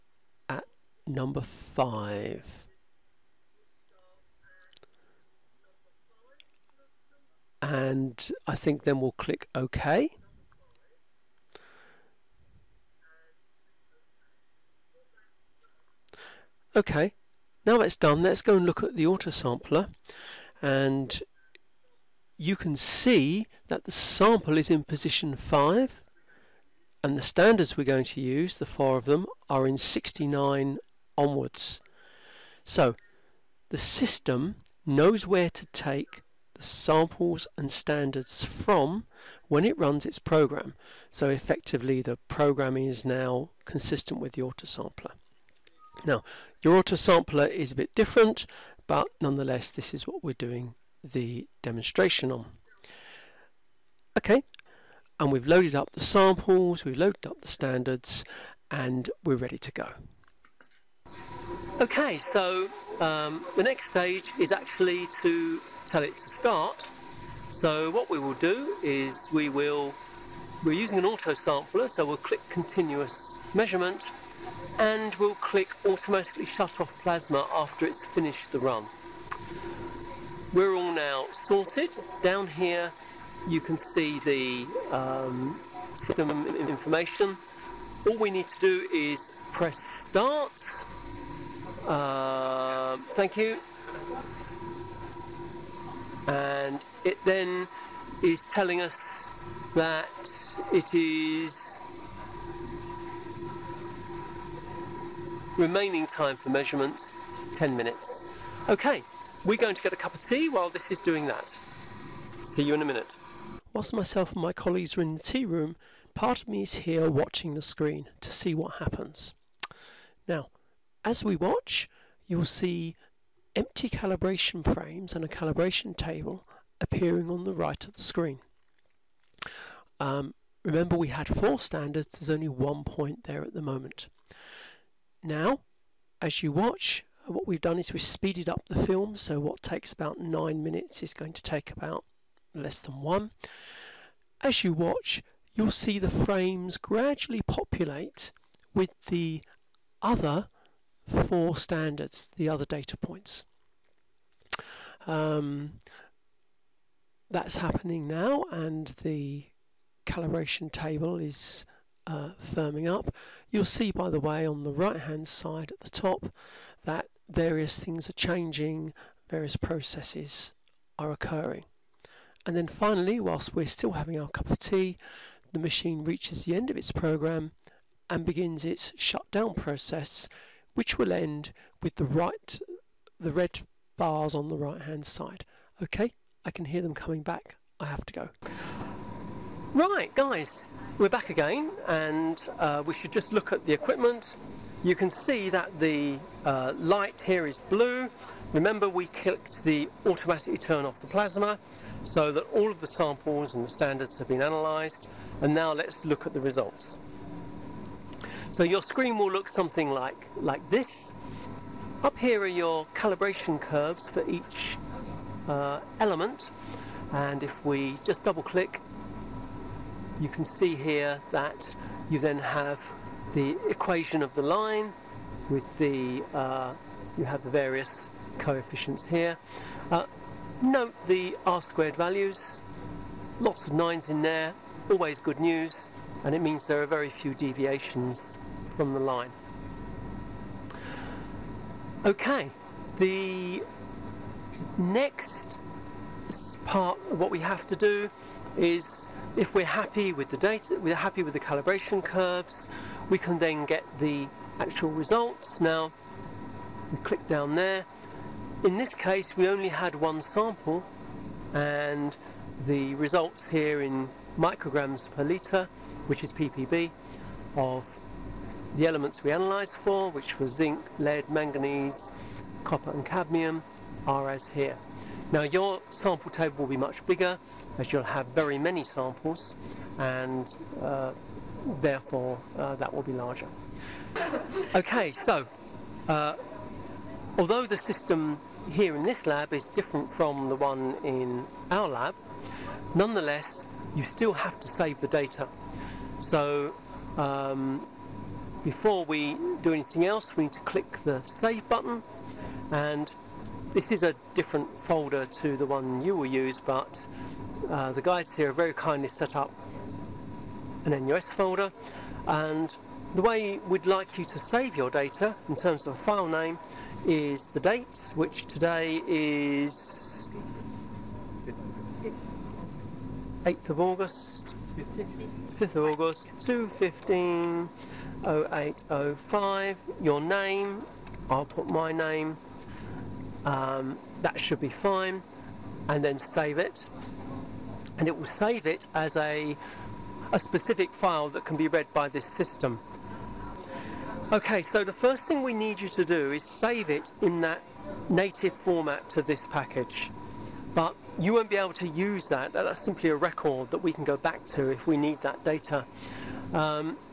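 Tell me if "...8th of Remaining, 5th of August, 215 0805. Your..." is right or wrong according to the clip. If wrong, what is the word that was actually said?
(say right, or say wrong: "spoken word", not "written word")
wrong: "August", not "Remaining".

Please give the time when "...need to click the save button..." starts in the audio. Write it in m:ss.
5:00.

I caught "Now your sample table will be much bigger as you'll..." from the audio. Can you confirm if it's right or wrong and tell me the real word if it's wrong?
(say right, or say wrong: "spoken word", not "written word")
right.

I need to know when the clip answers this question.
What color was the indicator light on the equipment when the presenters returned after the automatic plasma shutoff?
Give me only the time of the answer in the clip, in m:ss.
3:17.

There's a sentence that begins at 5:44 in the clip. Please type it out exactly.
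Okay, so the first thing we need you to do is save it in that native format to this package.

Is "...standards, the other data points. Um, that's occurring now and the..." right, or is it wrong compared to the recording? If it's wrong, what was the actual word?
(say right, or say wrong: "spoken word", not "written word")
wrong: "happening", not "occurring".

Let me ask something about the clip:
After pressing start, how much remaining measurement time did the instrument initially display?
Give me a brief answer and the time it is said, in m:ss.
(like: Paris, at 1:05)
10 minutes, at 1:47.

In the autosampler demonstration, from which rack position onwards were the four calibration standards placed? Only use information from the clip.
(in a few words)
69.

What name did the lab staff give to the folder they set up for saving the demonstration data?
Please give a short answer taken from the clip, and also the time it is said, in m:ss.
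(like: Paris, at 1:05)
NUS folder, at 5:11.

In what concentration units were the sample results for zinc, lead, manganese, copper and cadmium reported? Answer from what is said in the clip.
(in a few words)
Micrograms per litre.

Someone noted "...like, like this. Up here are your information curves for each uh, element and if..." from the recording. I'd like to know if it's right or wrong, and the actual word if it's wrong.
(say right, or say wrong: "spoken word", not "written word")
wrong: "calibration", not "information".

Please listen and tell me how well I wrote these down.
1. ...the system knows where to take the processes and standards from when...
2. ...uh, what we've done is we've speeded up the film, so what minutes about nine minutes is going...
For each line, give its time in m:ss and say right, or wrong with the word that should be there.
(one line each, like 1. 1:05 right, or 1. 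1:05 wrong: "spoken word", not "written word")
1. 0:33 wrong: "samples", not "processes"
2. 2:17 wrong: "takes", not "minutes".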